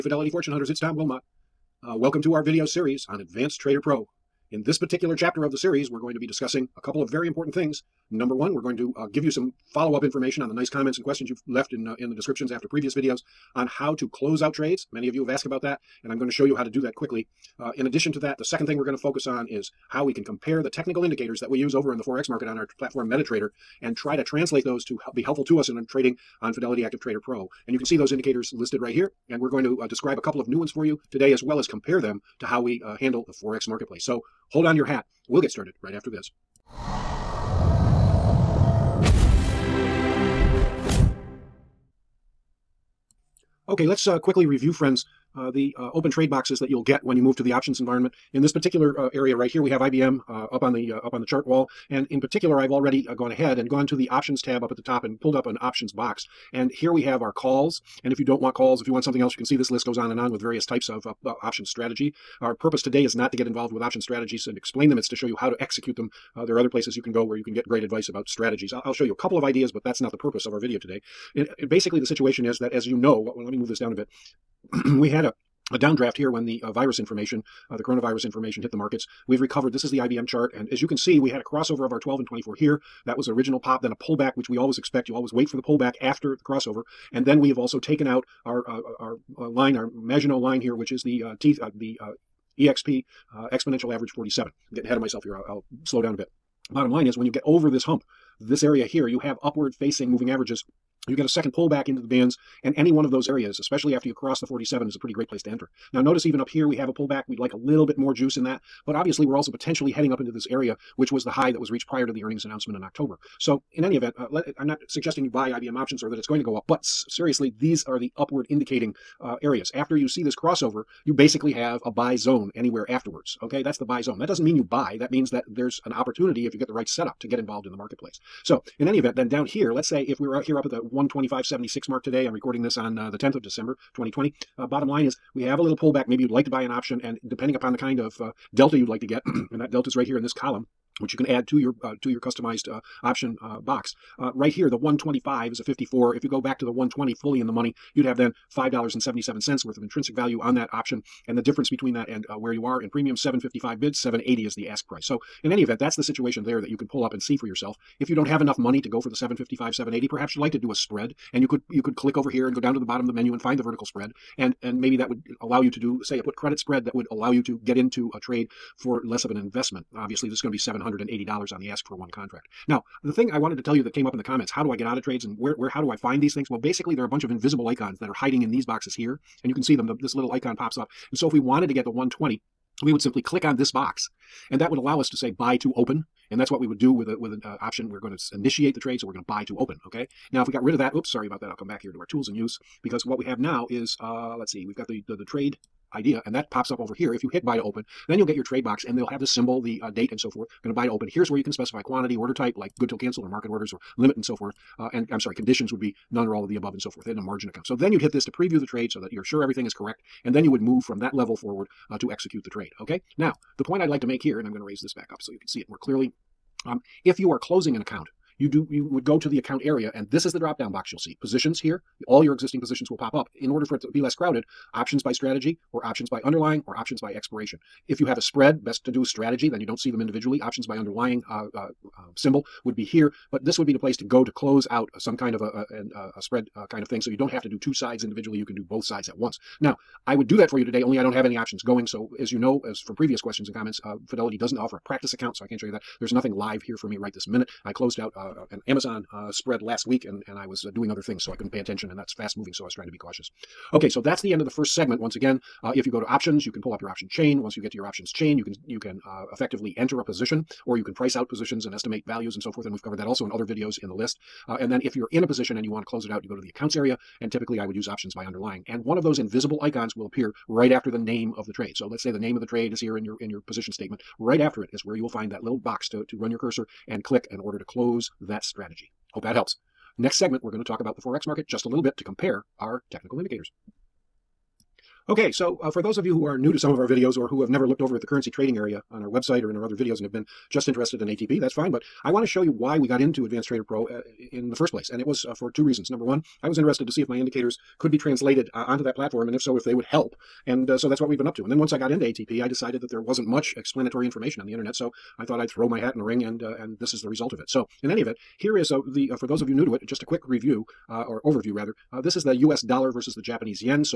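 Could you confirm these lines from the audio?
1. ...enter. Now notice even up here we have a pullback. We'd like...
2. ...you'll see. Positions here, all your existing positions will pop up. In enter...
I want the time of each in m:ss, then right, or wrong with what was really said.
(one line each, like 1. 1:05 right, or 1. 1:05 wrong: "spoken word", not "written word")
1. 1:45 right
2. 3:40 wrong: "order", not "enter".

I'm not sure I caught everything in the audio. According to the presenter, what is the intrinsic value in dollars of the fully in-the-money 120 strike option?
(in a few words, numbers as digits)
$5.77.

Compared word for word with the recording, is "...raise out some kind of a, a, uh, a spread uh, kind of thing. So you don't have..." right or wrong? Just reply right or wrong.
wrong.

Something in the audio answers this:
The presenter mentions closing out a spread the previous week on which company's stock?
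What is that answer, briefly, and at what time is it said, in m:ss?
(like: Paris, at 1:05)
Amazon, at 4:08.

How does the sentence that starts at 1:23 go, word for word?
That was the original pop, then a pullback, which we always expect.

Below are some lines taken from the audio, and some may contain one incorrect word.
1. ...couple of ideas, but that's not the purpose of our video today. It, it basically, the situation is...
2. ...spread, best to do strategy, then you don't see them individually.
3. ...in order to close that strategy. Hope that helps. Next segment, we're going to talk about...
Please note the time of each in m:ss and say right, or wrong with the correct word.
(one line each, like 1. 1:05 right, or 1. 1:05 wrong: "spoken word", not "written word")
1. 1:09 right
2. 3:48 right
3. 4:37 right.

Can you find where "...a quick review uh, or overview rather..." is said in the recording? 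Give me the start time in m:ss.
5:10.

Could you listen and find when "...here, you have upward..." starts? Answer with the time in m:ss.
1:38.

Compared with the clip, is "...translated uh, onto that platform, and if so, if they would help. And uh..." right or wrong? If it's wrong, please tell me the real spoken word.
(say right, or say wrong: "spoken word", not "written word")
right.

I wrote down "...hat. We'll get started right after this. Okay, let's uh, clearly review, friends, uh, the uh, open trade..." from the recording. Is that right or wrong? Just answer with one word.
wrong.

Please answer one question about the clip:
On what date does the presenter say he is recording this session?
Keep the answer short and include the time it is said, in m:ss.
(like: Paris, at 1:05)
10 December 2020, at 2:13.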